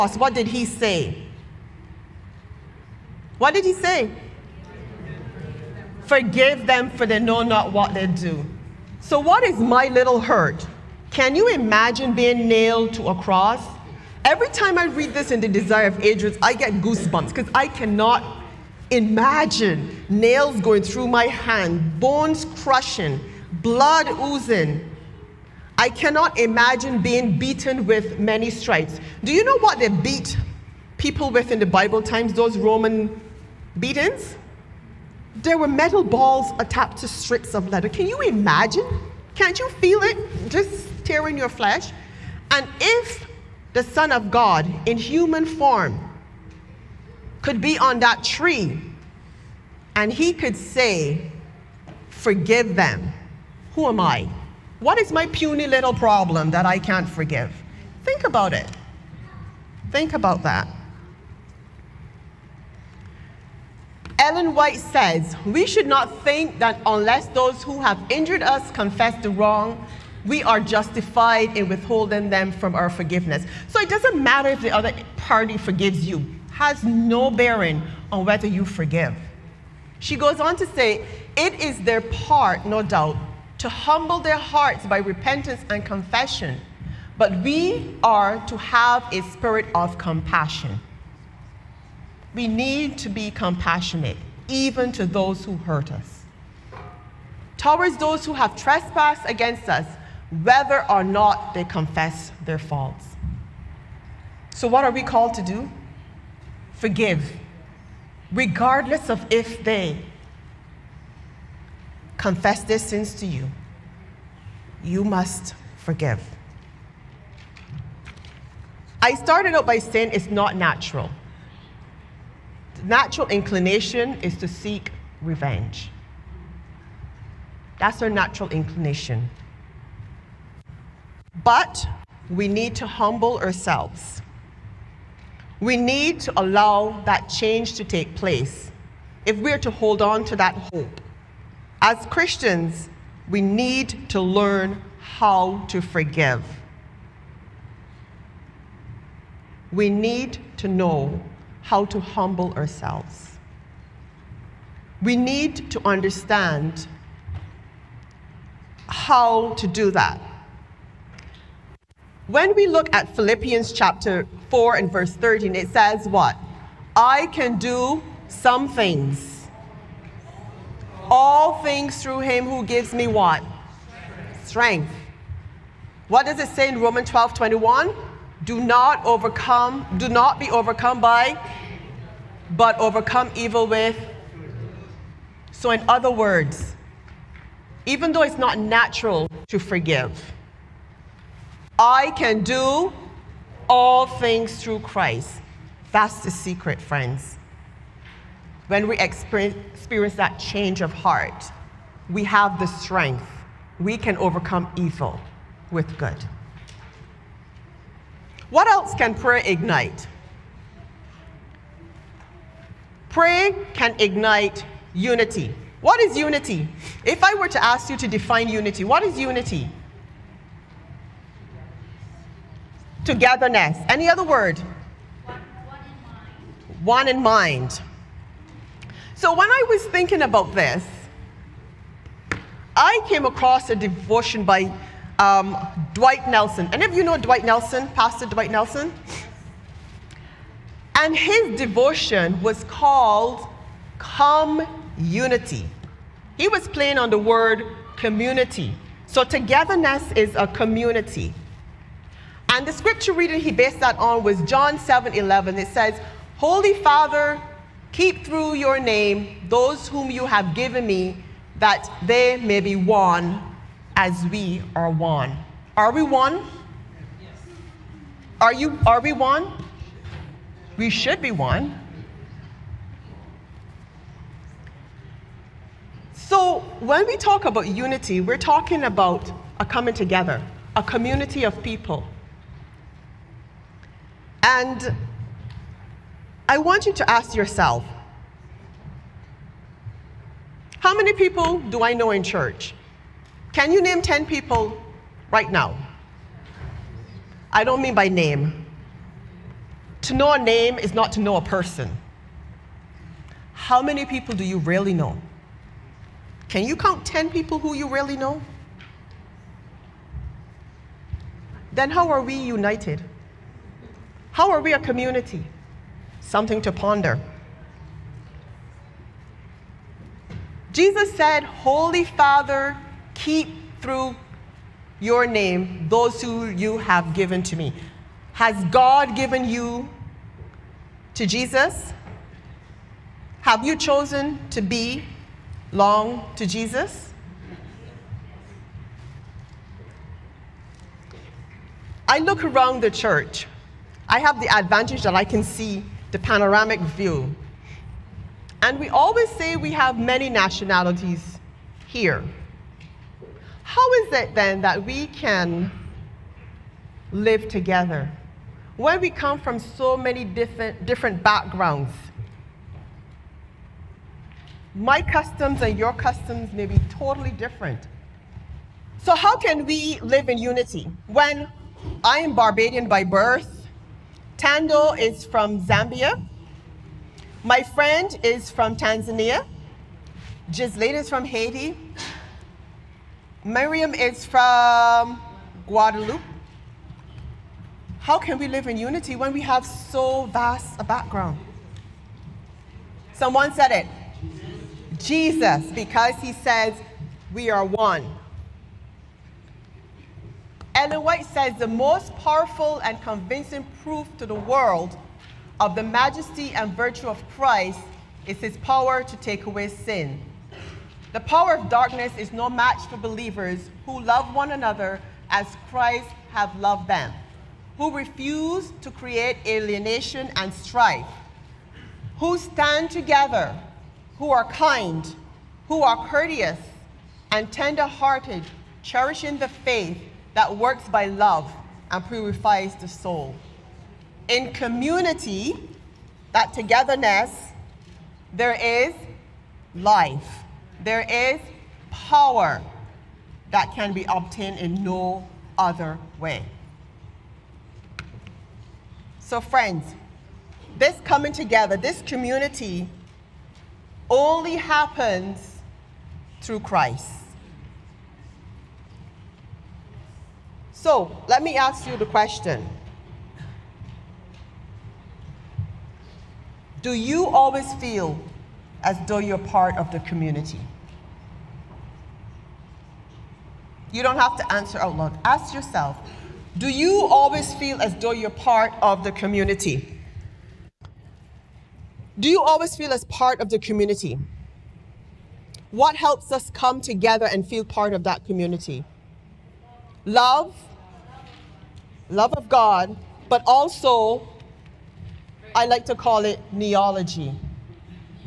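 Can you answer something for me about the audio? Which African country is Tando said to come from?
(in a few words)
Zambia.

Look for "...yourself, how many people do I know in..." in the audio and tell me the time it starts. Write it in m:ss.
4:47.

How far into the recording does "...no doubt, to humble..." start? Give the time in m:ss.
1:22.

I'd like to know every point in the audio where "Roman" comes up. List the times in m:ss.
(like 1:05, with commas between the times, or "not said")
0:32, 2:56.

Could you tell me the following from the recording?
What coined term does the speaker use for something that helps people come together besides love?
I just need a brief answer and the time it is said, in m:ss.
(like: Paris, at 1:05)
kneeology, at 8:16.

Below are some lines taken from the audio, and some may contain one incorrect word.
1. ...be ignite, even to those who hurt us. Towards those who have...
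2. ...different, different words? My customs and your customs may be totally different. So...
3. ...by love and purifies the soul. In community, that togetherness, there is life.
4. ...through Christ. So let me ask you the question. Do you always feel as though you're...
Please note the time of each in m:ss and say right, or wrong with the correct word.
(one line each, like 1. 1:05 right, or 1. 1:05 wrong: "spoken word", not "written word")
1. 1:33 wrong: "compassionate", not "ignite"
2. 6:00 wrong: "backgrounds", not "words"
3. 7:10 right
4. 7:36 right.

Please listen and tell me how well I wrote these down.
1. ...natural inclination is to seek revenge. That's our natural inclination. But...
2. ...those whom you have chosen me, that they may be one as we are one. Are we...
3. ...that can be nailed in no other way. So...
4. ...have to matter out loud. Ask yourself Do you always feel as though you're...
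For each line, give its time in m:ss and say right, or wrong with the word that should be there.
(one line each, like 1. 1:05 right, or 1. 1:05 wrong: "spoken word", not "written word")
1. 2:02 right
2. 4:19 wrong: "given", not "chosen"
3. 7:23 wrong: "obtained", not "nailed"
4. 7:54 wrong: "answer", not "matter".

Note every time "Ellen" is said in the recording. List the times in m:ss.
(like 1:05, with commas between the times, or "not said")
1:04, 6:40.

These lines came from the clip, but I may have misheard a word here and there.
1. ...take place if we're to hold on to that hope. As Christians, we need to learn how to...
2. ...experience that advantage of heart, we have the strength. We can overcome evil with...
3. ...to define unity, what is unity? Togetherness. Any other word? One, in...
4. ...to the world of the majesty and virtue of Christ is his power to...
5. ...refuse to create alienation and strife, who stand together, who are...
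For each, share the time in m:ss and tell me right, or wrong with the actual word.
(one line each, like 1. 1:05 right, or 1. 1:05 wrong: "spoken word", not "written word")
1. 2:17 right
2. 3:18 wrong: "change", not "advantage"
3. 3:37 right
4. 6:44 right
5. 6:57 right.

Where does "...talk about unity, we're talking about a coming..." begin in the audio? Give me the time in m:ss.
4:37.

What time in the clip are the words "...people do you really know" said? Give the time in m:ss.
5:04.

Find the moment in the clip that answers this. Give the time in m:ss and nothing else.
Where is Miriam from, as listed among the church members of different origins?
6:25.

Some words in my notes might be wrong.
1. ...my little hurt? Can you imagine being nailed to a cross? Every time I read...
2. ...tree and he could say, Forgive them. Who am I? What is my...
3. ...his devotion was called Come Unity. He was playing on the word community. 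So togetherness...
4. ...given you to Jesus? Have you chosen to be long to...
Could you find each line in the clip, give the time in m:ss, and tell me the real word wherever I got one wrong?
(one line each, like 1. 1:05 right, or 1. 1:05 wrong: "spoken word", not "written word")
1. 0:09 right
2. 0:48 right
3. 4:01 right
4. 5:29 right.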